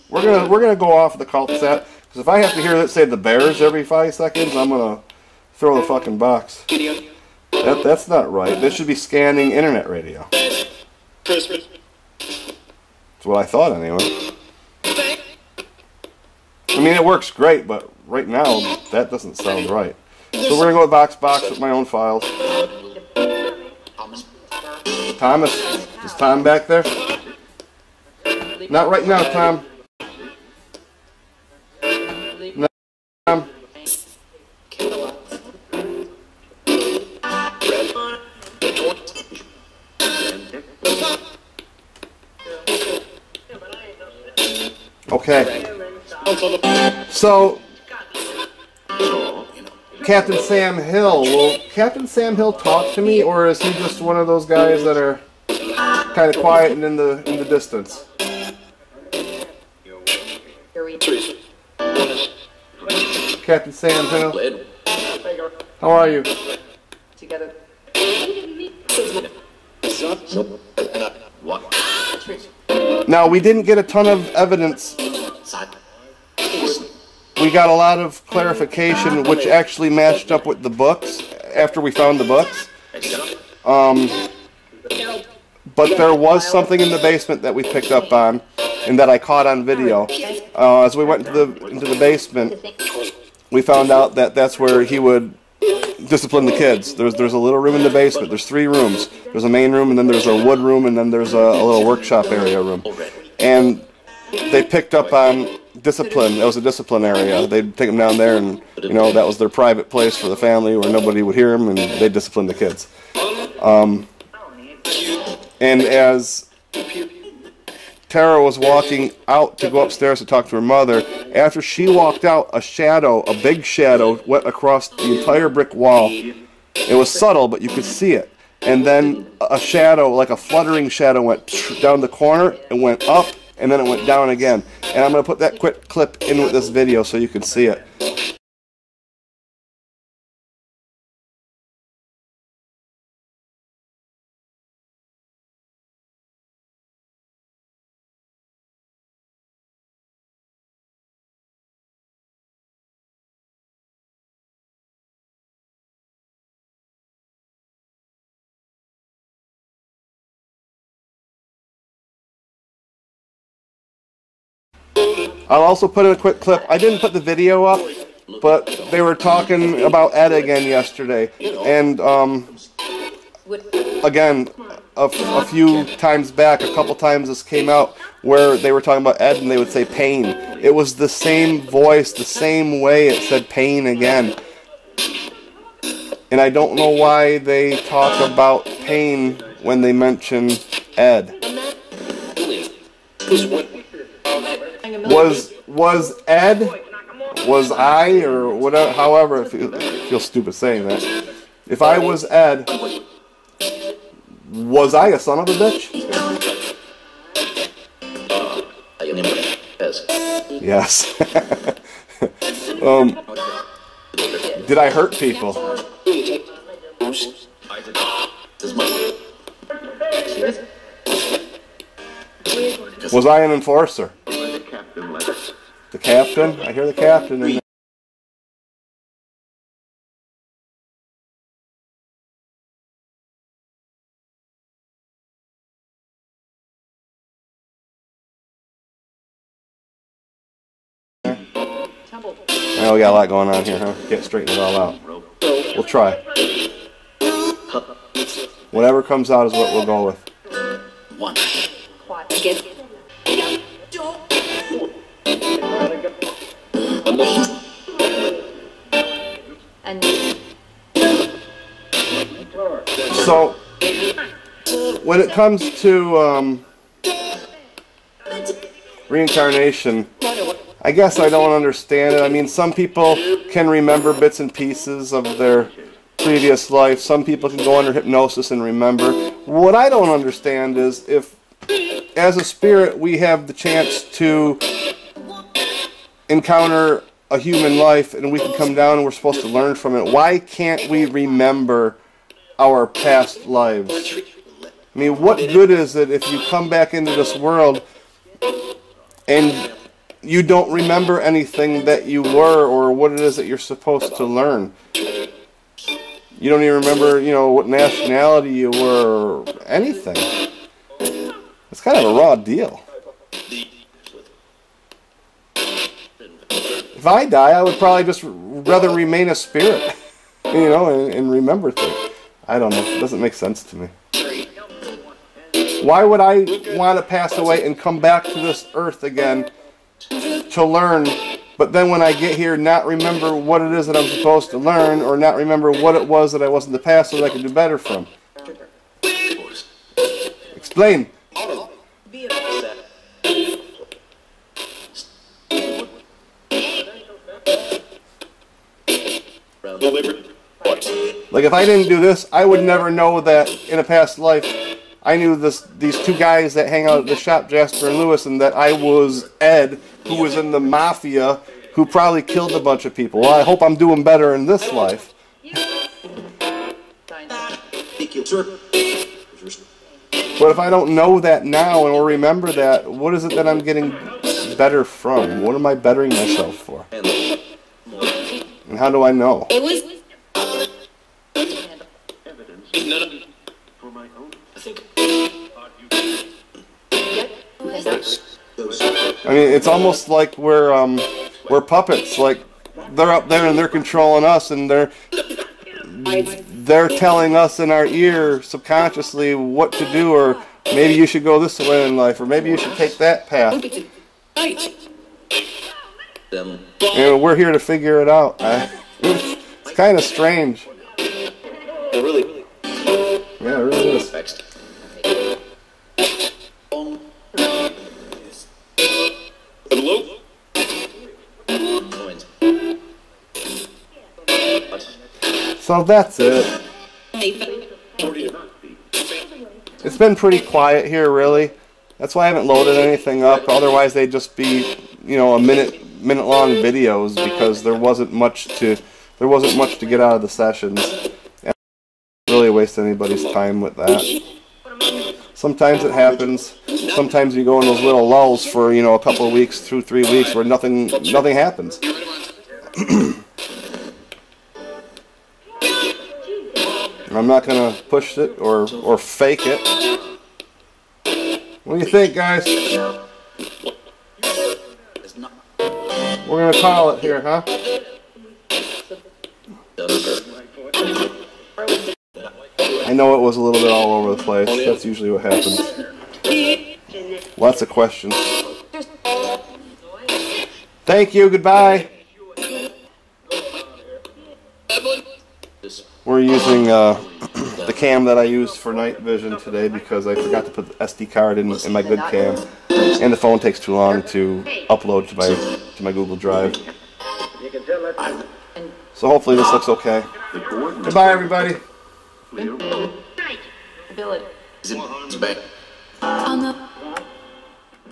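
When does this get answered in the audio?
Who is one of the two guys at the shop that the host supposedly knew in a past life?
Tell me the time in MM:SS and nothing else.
05:57.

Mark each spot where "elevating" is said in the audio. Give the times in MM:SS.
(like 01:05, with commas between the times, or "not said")
not said.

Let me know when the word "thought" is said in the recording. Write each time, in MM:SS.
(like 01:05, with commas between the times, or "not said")
00:13.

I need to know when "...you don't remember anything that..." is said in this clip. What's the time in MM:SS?
05:00.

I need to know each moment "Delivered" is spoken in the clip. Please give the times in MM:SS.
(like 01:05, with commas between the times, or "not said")
05:49.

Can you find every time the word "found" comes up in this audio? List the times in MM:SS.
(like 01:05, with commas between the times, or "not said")
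01:21, 01:33.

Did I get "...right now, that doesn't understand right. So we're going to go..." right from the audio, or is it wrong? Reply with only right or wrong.
wrong.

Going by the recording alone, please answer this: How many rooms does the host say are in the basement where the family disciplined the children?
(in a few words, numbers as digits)
3.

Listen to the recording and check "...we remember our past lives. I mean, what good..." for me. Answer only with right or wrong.
right.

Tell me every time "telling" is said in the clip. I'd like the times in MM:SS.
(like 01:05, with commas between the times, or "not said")
06:36.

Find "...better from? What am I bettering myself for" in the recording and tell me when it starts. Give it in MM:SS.
06:14.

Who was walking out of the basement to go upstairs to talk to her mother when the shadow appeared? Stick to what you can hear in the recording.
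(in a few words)
Tara.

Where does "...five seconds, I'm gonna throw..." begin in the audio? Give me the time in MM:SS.
00:03.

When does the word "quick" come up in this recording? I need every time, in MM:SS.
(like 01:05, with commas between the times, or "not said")
02:15, 02:46.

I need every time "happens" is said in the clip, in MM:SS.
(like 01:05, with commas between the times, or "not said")
07:25, 07:31, 07:55.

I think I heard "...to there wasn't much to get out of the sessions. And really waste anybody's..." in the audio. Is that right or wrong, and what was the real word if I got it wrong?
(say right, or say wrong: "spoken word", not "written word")
right.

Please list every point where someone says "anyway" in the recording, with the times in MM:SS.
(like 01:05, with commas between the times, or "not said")
00:13.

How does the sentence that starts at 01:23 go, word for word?
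Um, but there was something in the basement that we picked up on and that I caught on video.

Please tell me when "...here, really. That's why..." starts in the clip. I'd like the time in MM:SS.
07:10.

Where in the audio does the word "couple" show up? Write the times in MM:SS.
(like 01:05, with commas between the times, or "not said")
02:56, 07:28.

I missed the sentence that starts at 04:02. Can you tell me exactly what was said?
Oh, we got a lot going on here, huh?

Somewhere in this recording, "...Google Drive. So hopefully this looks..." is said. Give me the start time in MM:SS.
08:15.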